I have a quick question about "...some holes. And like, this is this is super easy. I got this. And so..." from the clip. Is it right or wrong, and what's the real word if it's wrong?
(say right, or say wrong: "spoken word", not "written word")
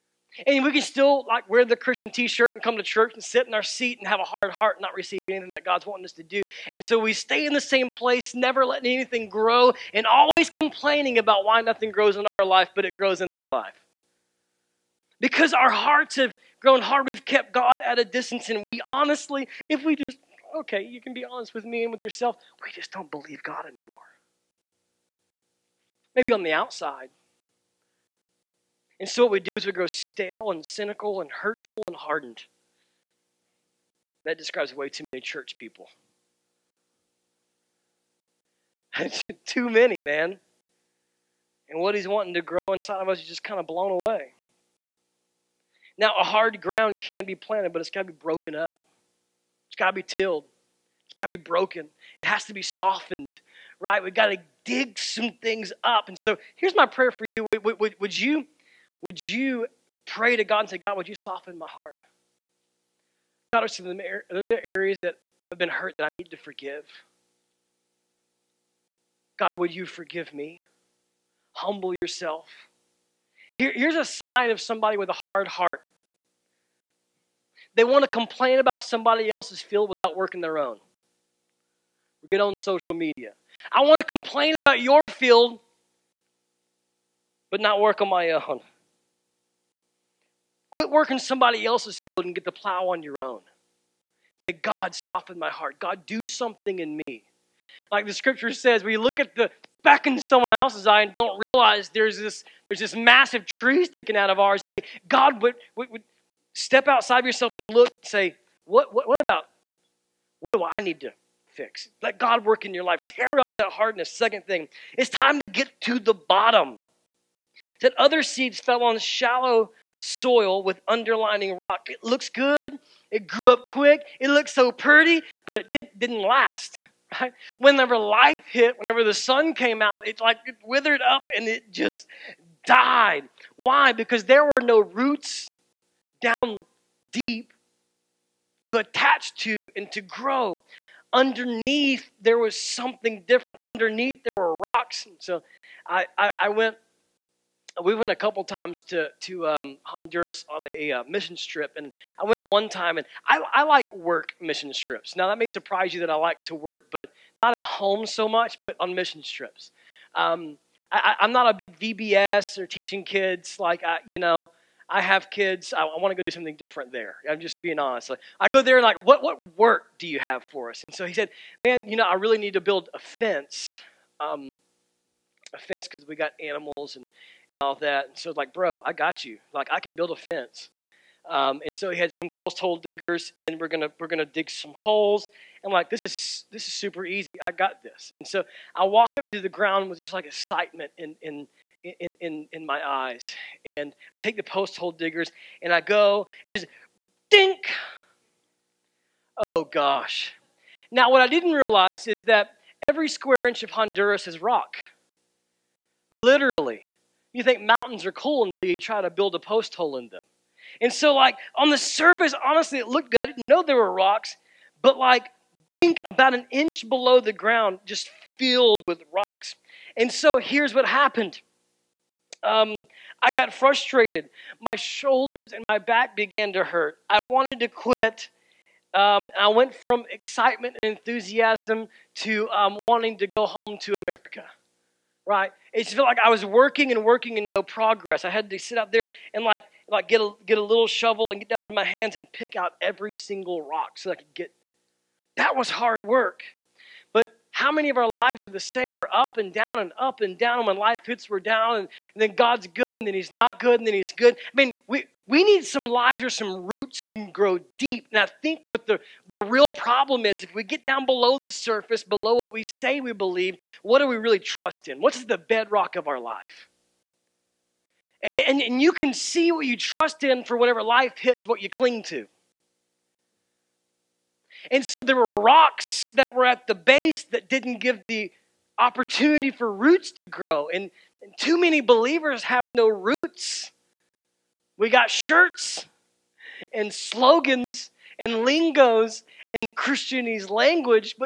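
right.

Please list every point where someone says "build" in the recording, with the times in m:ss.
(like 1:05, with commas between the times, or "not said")
2:52, 2:59, 3:29.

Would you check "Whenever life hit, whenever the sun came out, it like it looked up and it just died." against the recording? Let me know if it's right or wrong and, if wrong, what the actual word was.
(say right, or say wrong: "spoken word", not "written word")
wrong: "withered", not "looked".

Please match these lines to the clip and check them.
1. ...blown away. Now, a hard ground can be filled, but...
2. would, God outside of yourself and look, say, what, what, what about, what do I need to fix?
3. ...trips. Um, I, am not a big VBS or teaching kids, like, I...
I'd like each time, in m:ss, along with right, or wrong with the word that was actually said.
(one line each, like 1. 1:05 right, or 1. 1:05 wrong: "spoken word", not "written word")
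1. 0:43 wrong: "planted", not "filled"
2. 1:45 wrong: "Step", not "God"
3. 2:39 right.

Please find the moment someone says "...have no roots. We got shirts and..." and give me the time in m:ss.
4:42.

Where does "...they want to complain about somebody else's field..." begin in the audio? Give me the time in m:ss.
1:17.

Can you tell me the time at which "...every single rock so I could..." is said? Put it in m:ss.
4:02.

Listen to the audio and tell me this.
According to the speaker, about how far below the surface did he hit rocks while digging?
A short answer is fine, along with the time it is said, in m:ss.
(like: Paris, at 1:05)
About an inch, at 3:36.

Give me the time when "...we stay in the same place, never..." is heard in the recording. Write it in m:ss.
0:07.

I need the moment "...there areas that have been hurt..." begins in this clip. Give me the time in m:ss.
1:04.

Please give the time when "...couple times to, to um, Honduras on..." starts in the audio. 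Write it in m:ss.
2:28.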